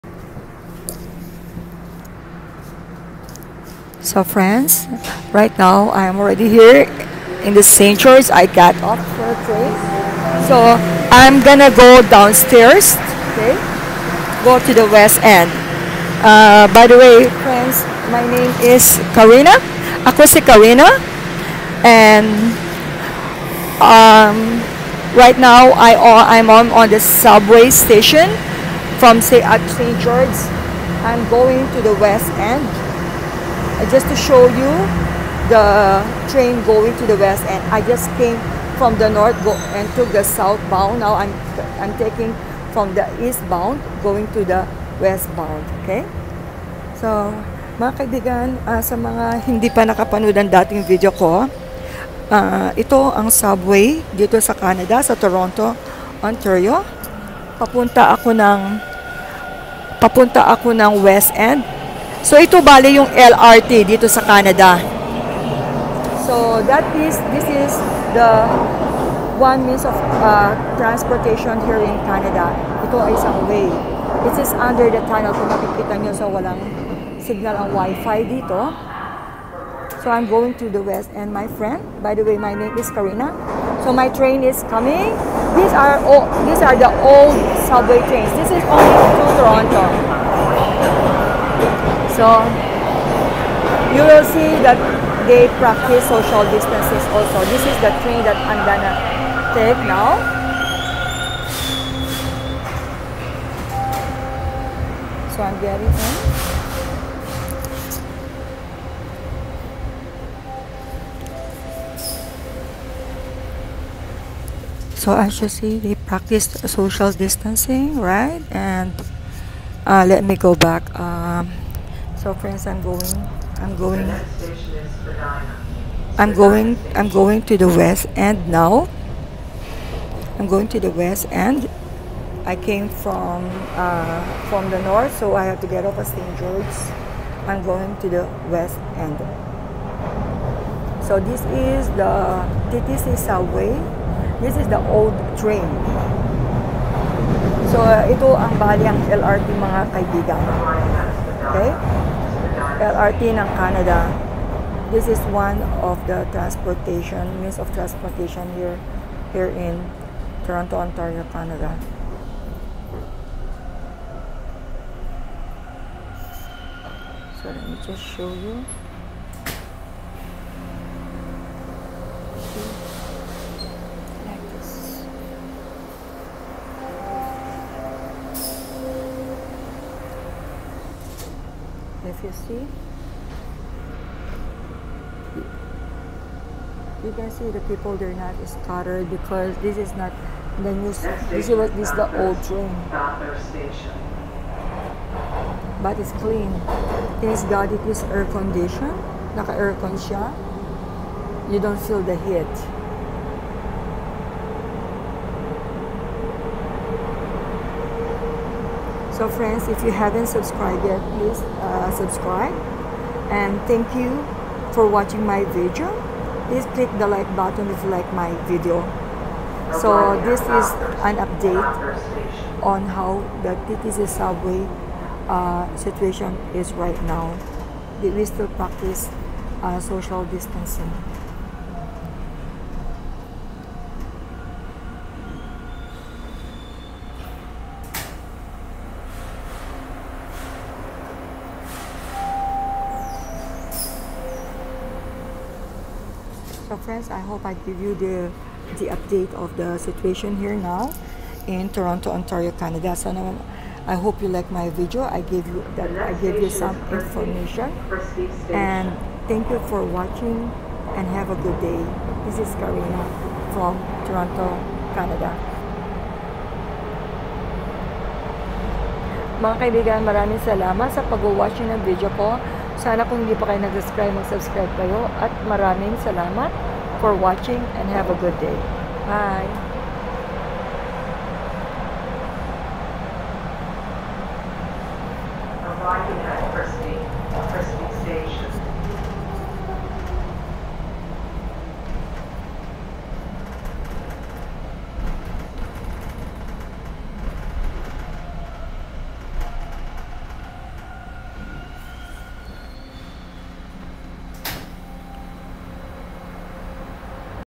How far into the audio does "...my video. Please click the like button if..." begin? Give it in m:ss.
3:35.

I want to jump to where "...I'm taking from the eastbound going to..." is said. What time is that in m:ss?
0:41.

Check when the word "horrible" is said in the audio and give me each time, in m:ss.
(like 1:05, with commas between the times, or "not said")
not said.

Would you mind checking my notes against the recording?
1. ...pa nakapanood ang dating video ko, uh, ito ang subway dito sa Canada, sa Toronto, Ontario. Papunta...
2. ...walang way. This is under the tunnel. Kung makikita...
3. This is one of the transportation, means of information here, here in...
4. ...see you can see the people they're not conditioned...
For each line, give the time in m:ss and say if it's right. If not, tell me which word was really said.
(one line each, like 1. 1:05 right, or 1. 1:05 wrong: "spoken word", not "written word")
1. 0:49 right
2. 1:13 wrong: "isang", not "walang"
3. 2:34 wrong: "transportation", not "information"
4. 3:02 wrong: "scattered", not "conditioned".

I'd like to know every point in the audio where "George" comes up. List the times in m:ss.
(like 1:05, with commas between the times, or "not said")
0:07, 0:30, 2:16.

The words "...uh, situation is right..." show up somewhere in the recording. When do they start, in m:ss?
3:45.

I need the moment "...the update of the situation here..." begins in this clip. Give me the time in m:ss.
4:08.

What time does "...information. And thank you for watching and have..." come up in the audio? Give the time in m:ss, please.
4:16.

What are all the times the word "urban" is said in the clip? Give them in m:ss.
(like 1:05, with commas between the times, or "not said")
not said.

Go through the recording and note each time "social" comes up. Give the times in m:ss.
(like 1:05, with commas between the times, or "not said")
1:36, 1:56, 3:49.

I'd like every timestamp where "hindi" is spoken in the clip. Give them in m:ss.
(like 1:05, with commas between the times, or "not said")
0:49, 4:33.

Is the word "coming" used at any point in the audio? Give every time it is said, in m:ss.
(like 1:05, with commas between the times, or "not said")
1:24.